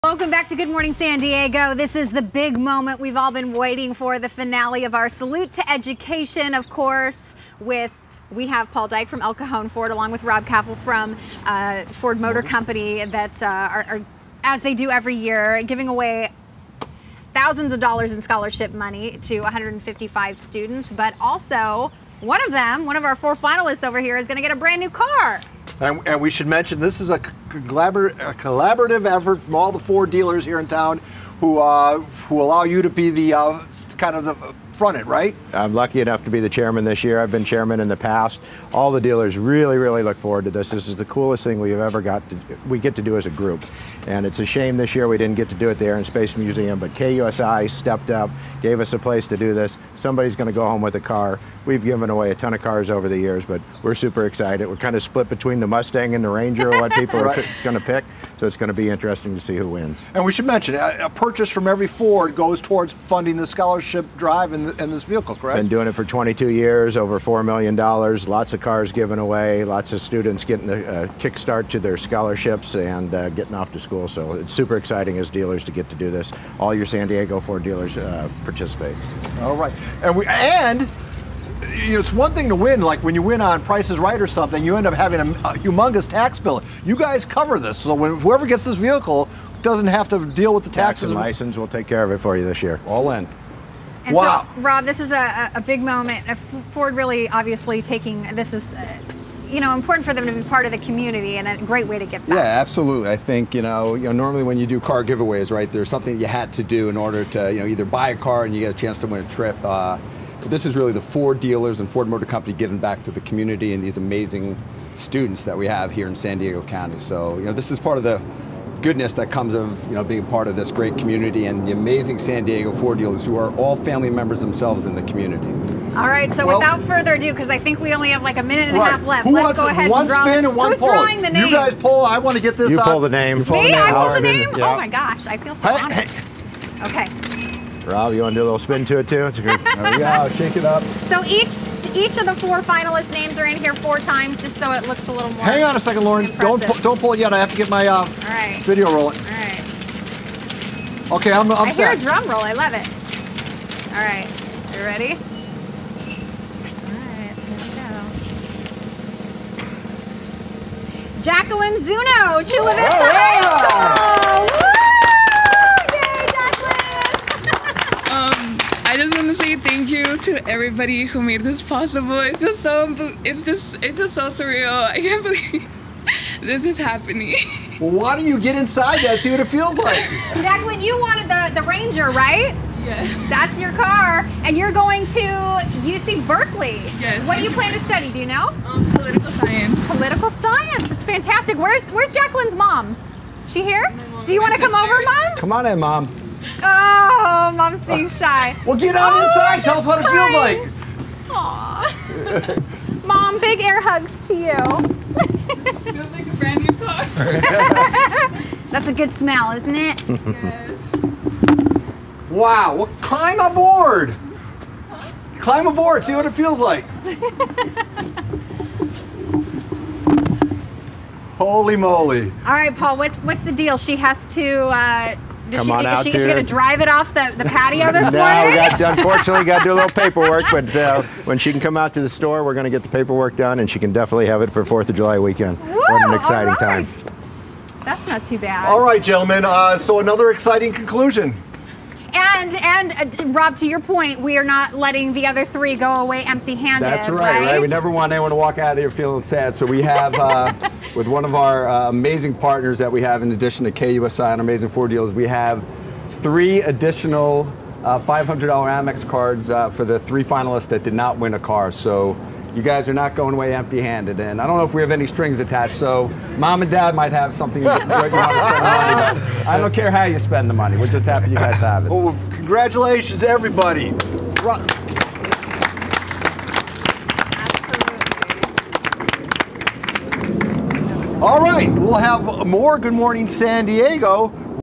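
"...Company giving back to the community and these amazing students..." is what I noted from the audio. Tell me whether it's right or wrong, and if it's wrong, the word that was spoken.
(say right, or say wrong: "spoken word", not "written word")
right.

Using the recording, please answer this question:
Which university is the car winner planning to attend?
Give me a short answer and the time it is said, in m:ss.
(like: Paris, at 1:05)
UC Berkeley, at 3:05.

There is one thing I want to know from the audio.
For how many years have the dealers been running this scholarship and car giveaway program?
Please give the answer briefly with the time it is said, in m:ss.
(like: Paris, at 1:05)
22 years, at 1:06.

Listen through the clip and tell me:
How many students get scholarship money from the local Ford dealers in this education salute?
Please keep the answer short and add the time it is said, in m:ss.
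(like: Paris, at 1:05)
155, at 0:19.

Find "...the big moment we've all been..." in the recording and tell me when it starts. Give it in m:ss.
0:02.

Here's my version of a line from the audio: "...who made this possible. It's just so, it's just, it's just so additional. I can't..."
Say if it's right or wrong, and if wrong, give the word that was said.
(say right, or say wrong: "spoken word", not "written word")
wrong: "surreal", not "additional".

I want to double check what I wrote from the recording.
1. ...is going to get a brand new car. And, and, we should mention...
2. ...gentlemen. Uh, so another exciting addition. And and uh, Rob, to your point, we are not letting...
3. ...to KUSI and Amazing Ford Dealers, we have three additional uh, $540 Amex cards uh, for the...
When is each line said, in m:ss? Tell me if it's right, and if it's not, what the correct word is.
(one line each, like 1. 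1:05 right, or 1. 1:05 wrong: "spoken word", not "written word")
1. 0:24 right
2. 3:59 wrong: "conclusion", not "addition"
3. 4:13 wrong: "500", not "540".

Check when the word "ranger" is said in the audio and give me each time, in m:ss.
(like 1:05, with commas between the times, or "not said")
0:56, 3:01.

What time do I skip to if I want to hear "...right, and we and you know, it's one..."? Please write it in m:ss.
1:19.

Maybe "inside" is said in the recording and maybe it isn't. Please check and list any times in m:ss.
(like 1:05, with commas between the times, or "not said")
2:58, 3:19.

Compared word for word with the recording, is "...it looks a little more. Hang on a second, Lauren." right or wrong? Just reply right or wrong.
right.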